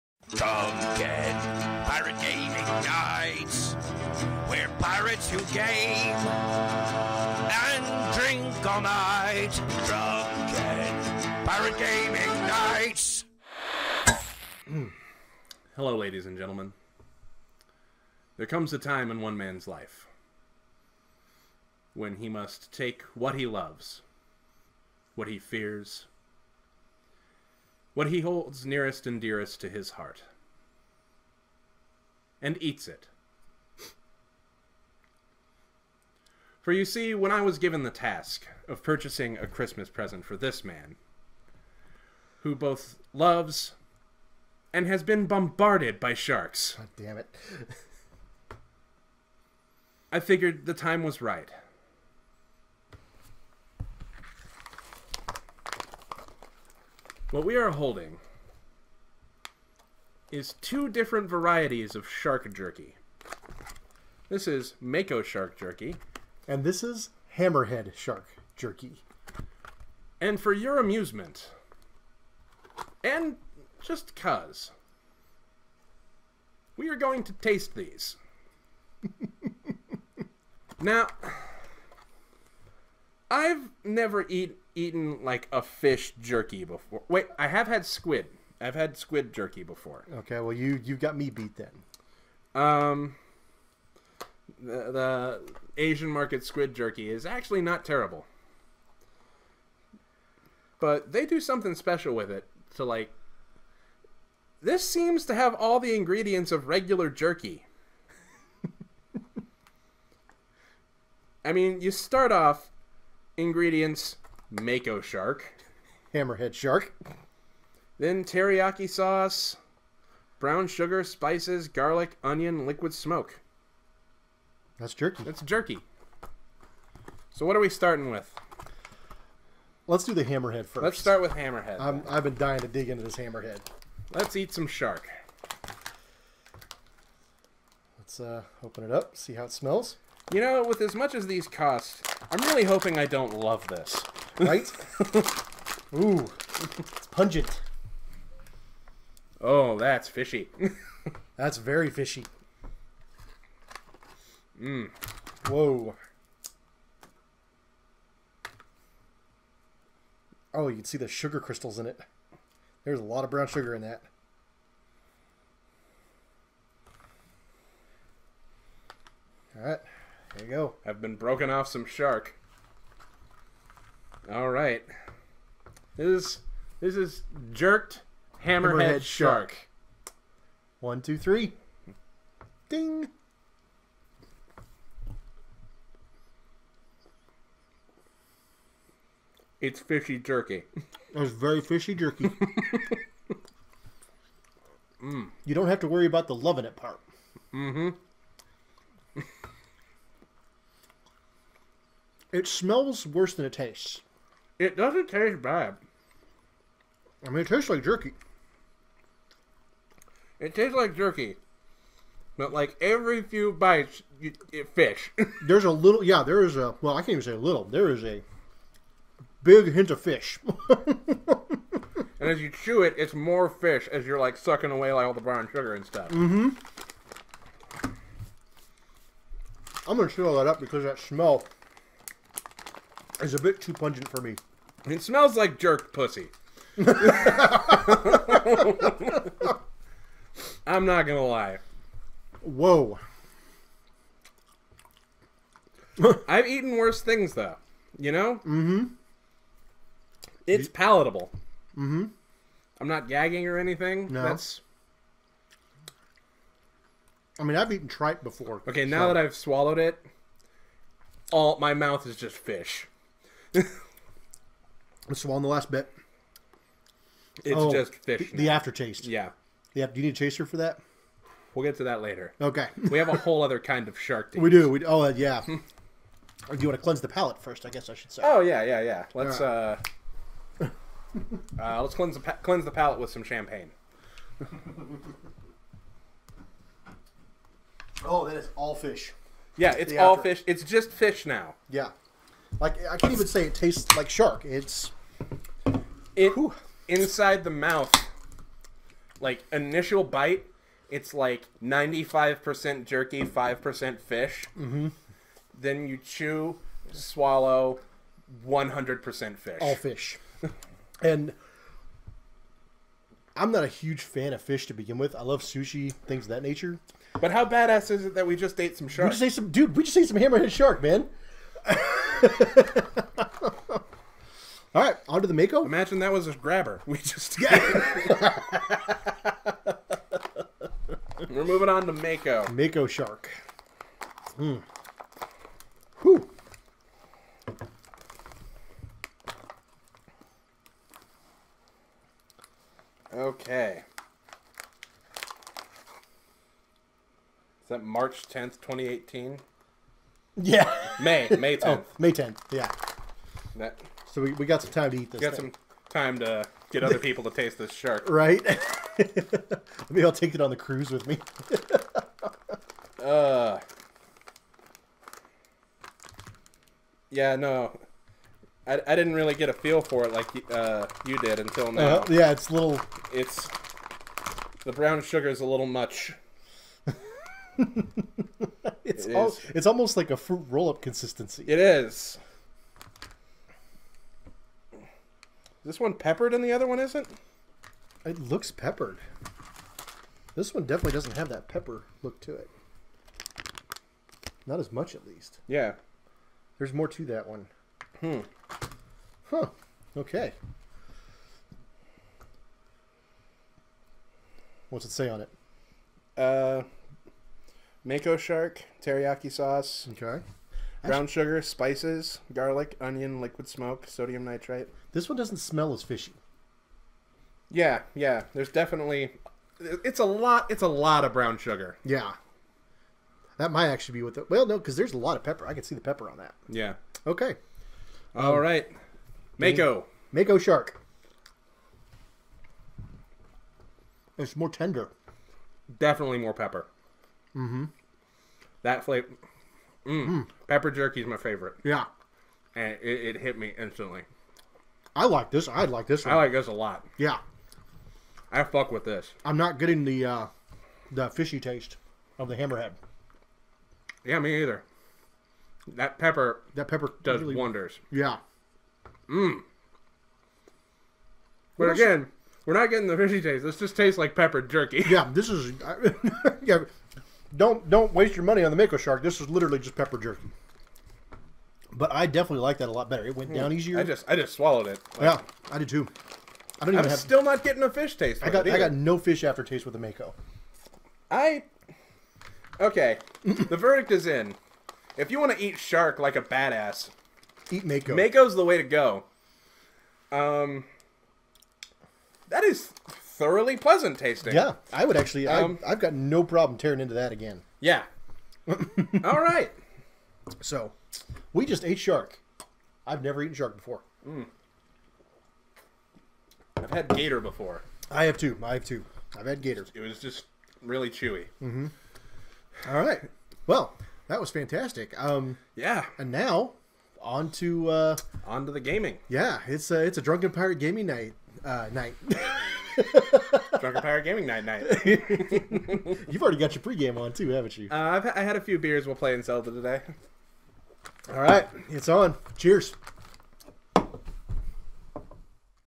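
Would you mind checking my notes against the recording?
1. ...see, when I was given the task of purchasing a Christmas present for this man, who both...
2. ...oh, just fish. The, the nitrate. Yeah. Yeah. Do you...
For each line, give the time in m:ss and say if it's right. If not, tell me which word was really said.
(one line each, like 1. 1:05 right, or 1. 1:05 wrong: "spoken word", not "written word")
1. 0:36 right
2. 4:27 wrong: "aftertaste", not "nitrate".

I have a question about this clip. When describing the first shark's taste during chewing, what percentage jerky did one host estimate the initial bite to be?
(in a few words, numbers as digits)
95.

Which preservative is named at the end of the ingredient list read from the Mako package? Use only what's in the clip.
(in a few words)
Sodium nitrate.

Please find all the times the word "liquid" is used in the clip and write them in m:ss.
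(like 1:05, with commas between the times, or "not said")
2:02, 6:53.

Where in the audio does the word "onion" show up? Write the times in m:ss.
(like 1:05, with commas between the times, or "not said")
2:02, 6:52.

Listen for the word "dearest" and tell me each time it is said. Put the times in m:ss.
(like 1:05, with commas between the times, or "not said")
0:29.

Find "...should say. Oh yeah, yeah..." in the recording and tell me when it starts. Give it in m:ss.
4:37.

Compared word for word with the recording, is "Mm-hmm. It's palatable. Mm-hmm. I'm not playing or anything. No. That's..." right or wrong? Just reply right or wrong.
wrong.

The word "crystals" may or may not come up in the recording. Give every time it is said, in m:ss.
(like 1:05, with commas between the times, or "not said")
2:41.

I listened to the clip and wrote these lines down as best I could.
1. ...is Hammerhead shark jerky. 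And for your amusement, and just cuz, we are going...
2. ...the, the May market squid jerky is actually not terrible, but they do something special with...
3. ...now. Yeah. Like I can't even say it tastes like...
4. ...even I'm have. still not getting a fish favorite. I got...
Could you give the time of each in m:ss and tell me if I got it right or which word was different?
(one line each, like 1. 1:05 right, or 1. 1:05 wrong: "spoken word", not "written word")
1. 1:06 right
2. 1:34 wrong: "Asian", not "May"
3. 4:51 right
4. 7:56 wrong: "taste", not "favorite".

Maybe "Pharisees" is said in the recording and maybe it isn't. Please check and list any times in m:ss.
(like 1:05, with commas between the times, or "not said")
not said.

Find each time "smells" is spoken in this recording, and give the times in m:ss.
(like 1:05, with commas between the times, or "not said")
2:19, 3:22, 3:50, 3:55, 6:55.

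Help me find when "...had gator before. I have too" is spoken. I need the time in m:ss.
8:26.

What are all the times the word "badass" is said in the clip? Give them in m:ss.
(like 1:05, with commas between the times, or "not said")
5:17, 8:06.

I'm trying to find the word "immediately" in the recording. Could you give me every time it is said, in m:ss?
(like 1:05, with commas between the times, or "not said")
not said.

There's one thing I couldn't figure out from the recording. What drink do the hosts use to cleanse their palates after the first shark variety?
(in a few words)
Champagne.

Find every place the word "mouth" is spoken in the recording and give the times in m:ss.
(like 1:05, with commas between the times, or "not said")
4:21, 4:57.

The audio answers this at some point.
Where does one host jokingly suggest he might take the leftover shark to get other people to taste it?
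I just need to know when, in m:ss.
6:00.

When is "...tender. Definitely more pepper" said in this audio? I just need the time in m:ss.
7:14.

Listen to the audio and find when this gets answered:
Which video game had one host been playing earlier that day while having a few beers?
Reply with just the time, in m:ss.
8:49.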